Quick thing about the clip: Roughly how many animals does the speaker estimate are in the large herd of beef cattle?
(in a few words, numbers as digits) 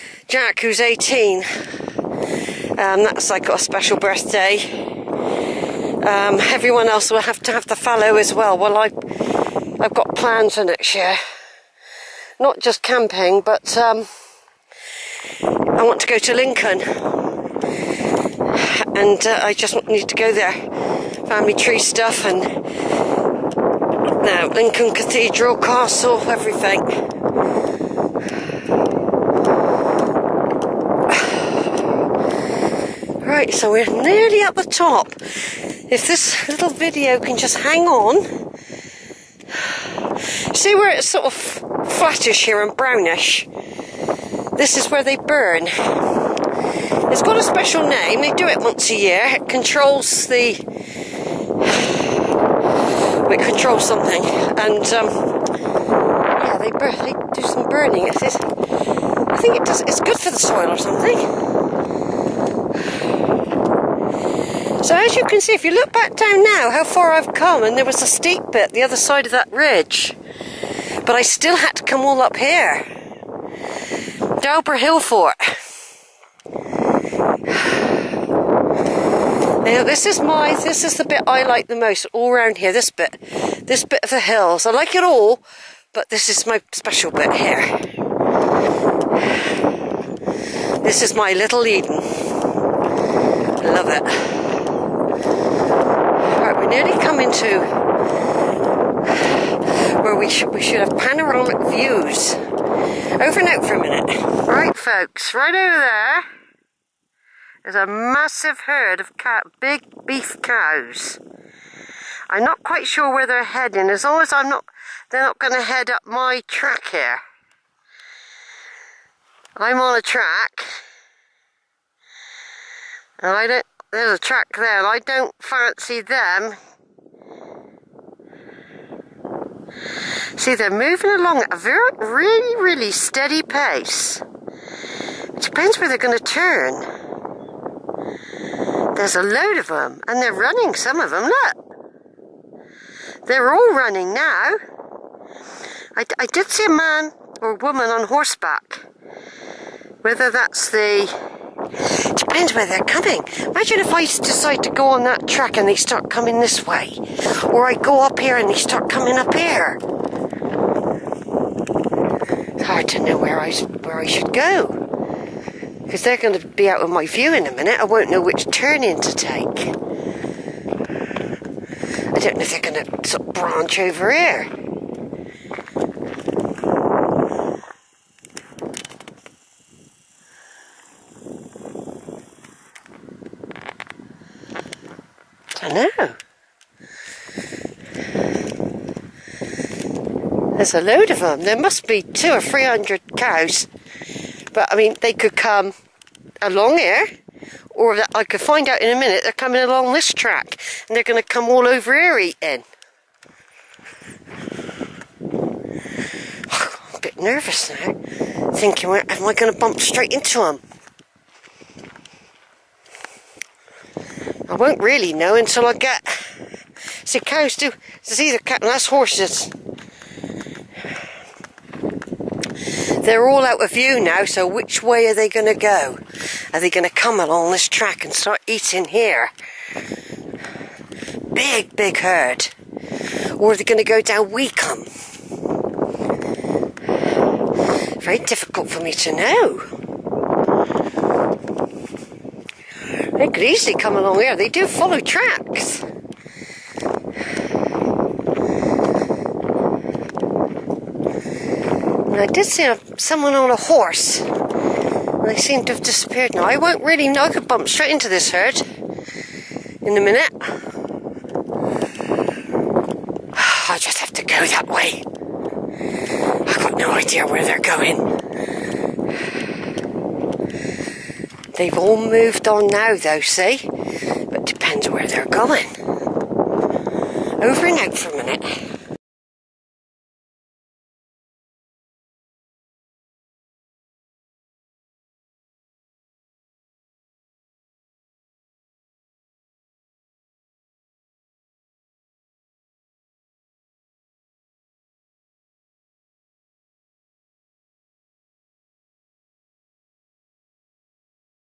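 200 or 300.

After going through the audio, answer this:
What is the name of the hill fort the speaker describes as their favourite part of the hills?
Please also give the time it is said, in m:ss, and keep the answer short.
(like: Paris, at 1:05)
Dauber Hill Fort, at 1:14.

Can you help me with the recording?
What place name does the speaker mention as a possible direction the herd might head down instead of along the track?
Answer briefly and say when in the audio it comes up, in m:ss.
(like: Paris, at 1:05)
Weacombe, at 3:54.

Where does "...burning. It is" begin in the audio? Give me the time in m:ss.
0:57.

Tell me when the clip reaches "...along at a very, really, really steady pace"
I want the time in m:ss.
2:11.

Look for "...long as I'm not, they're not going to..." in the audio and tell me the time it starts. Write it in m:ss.
1:54.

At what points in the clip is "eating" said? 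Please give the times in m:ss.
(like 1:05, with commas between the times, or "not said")
3:22, 3:48.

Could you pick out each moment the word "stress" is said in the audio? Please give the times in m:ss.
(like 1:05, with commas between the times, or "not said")
not said.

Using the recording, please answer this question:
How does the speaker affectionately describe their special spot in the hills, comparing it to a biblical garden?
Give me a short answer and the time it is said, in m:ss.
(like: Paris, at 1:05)
My little Eden, at 1:31.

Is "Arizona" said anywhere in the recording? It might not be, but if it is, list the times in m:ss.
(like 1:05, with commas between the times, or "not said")
not said.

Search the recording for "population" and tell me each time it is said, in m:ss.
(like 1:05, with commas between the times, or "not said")
not said.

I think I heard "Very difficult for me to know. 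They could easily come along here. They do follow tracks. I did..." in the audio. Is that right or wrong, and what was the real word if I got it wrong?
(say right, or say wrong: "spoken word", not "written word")
right.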